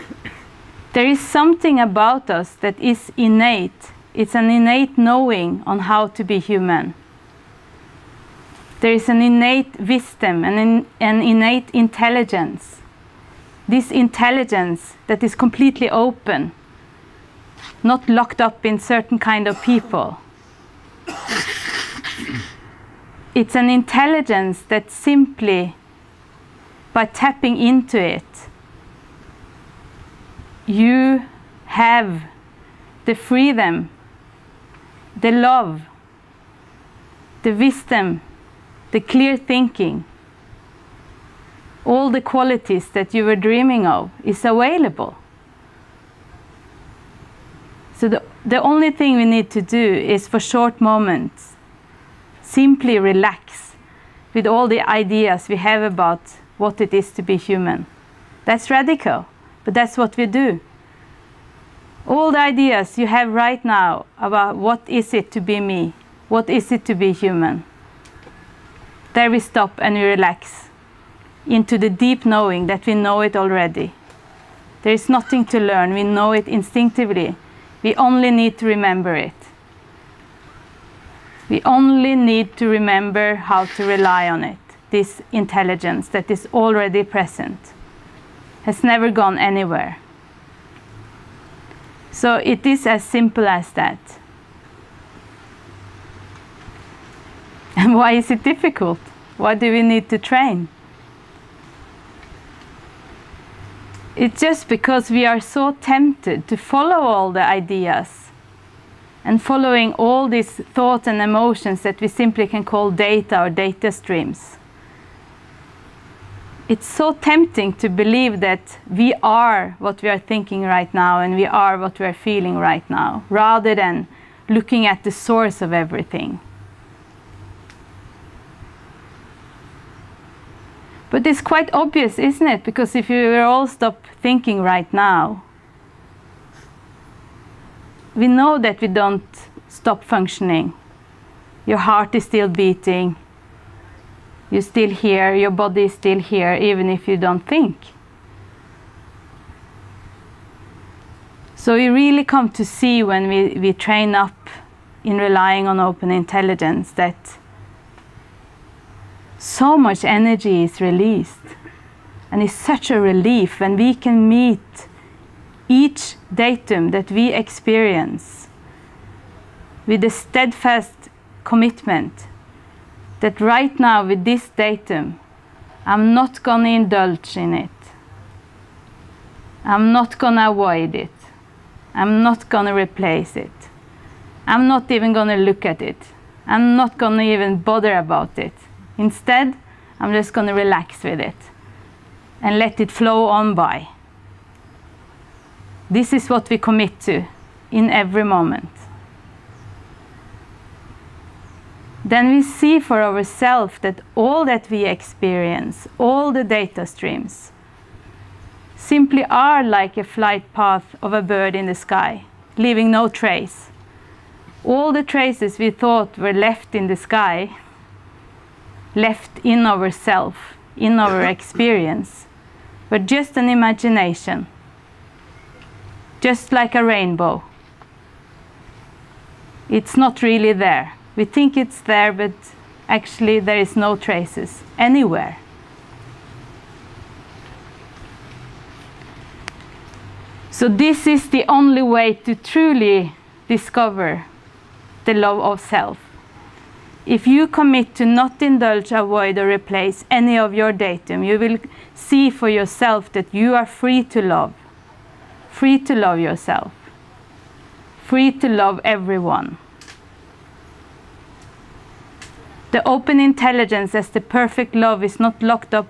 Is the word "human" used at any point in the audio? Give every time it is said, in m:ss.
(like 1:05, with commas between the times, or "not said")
0:06, 0:57, 1:07.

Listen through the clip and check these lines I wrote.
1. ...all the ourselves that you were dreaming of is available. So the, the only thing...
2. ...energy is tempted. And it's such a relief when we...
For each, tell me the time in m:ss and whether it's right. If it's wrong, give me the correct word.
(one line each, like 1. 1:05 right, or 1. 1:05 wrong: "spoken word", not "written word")
1. 0:41 wrong: "qualities", not "ourselves"
2. 2:40 wrong: "released", not "tempted".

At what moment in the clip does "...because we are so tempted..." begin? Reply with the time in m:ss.
1:44.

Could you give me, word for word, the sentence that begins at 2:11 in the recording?
But it's quite obvious, isn't it?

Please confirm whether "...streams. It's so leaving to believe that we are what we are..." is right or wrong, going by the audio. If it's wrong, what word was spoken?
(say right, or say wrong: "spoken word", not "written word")
wrong: "tempting", not "leaving".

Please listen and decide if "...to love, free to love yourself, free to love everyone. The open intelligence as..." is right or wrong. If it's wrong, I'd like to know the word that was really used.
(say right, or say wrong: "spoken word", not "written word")
right.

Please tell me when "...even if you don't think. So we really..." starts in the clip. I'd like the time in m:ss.
2:26.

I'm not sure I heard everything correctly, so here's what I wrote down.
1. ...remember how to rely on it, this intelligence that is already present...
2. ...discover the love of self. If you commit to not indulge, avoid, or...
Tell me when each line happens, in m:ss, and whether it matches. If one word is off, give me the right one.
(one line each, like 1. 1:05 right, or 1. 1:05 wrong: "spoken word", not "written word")
1. 1:22 right
2. 4:03 right.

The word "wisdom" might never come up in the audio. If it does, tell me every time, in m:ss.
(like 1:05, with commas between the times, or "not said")
0:09, 0:37.